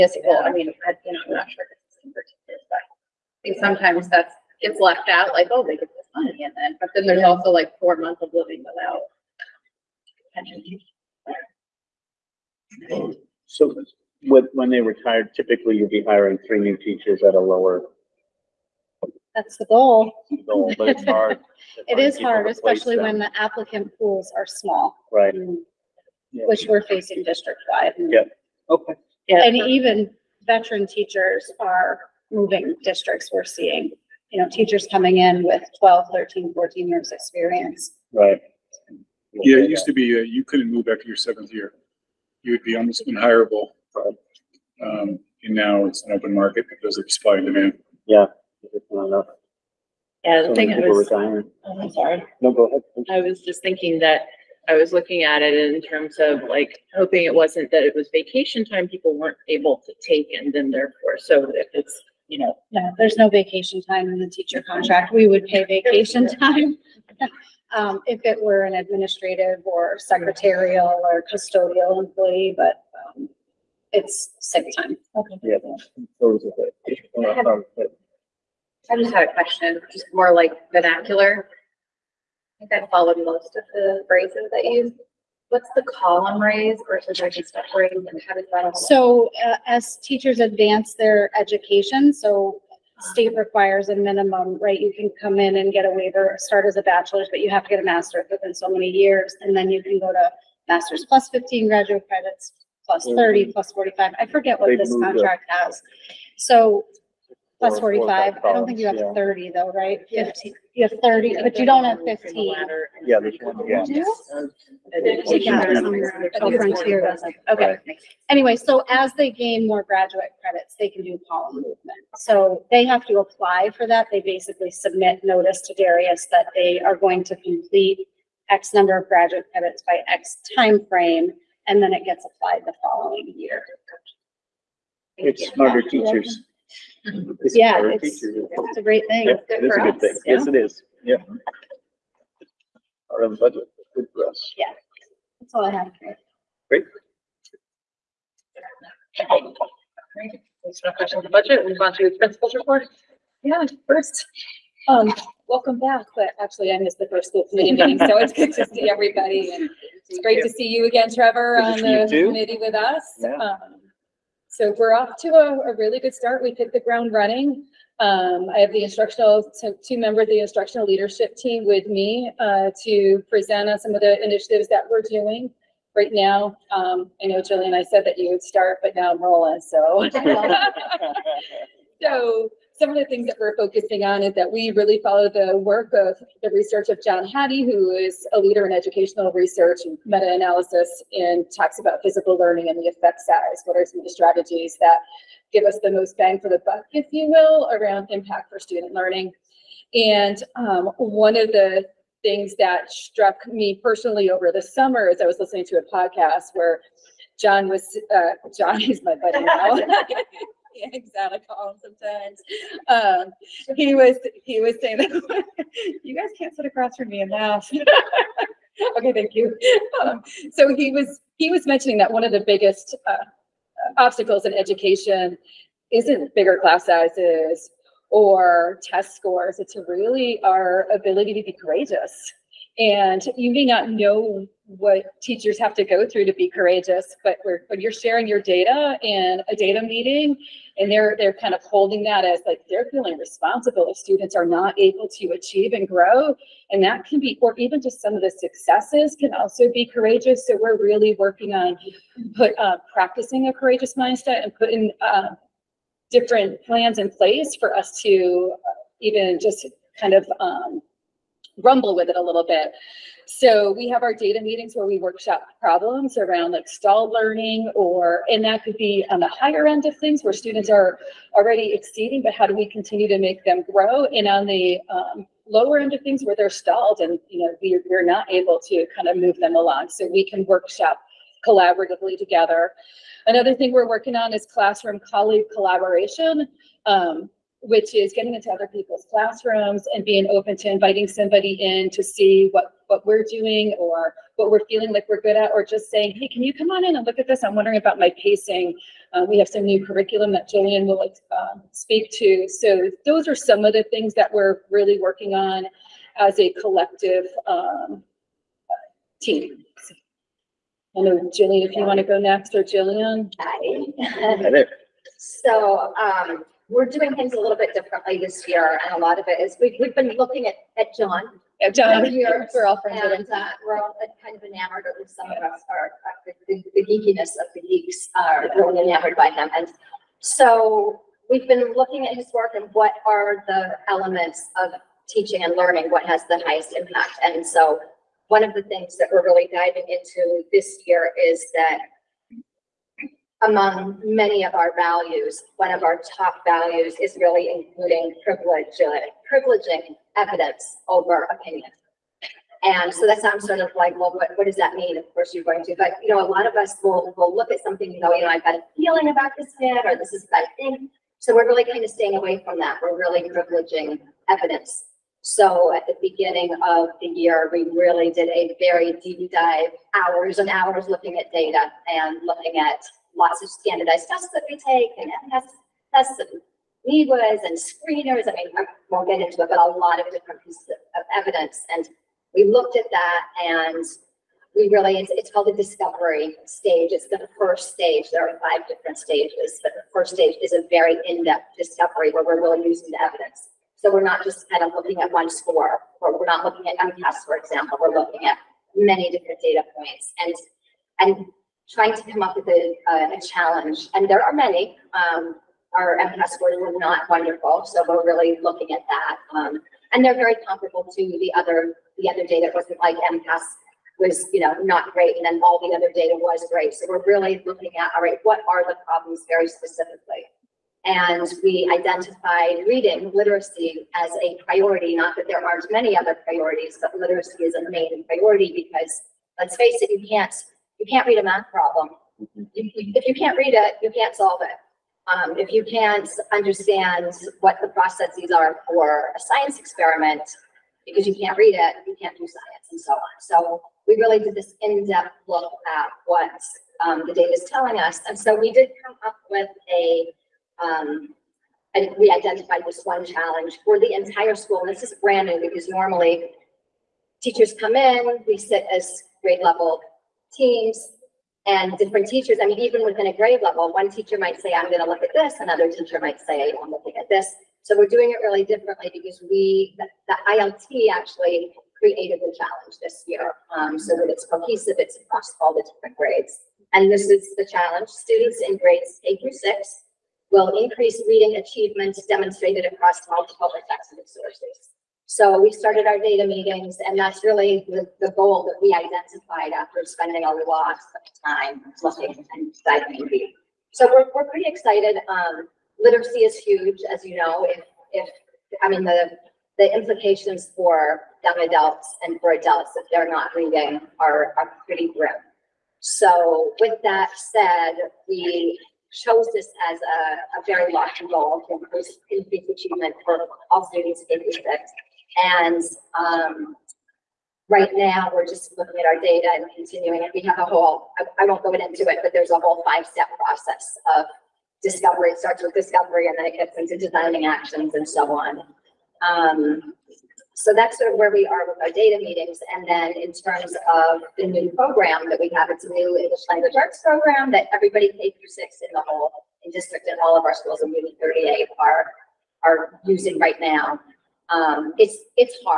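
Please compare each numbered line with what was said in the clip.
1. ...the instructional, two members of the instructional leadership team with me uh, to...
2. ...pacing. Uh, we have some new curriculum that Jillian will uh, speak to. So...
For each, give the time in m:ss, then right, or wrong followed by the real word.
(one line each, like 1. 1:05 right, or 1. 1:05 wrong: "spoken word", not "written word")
1. 2:48 right
2. 4:58 right.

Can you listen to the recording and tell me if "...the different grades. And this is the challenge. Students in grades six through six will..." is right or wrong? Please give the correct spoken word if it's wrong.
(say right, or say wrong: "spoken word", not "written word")
wrong: "eight", not "six".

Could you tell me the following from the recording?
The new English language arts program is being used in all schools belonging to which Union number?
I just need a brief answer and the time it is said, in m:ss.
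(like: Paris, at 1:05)
38, at 9:00.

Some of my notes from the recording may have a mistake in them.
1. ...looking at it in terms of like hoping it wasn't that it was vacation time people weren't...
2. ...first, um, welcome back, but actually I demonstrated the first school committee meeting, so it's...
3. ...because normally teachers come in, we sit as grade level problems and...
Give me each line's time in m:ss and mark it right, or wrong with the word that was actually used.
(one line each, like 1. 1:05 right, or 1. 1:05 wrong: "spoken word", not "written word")
1. 0:54 right
2. 2:33 wrong: "missed", not "demonstrated"
3. 7:35 wrong: "teams", not "problems".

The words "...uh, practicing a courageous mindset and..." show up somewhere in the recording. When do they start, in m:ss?
4:12.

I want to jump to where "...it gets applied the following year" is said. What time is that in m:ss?
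2:11.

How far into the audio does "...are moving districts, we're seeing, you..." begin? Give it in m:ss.
0:31.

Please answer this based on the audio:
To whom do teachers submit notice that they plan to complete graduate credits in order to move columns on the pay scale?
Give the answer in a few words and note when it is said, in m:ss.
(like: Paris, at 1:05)
Darius, at 2:05.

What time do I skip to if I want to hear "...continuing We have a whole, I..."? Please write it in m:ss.
8:39.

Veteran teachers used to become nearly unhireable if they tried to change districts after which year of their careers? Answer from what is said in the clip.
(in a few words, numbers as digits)
seventh year.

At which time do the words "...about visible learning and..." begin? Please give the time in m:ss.
3:11.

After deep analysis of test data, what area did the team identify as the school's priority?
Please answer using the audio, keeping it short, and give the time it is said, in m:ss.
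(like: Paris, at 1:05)
reading literacy, at 7:02.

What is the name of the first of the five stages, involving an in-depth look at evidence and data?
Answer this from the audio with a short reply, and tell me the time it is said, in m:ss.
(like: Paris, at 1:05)
discovery stage, at 6:25.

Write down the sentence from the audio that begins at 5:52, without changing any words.
And so that sounds sort of like, well, what, what does that mean?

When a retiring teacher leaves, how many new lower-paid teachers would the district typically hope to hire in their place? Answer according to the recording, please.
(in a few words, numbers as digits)
3.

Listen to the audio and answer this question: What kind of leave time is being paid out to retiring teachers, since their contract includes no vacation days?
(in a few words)
sick time.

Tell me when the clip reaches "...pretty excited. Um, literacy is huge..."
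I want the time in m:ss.
8:14.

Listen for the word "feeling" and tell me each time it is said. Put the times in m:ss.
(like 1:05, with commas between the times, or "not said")
4:02, 4:54, 5:58.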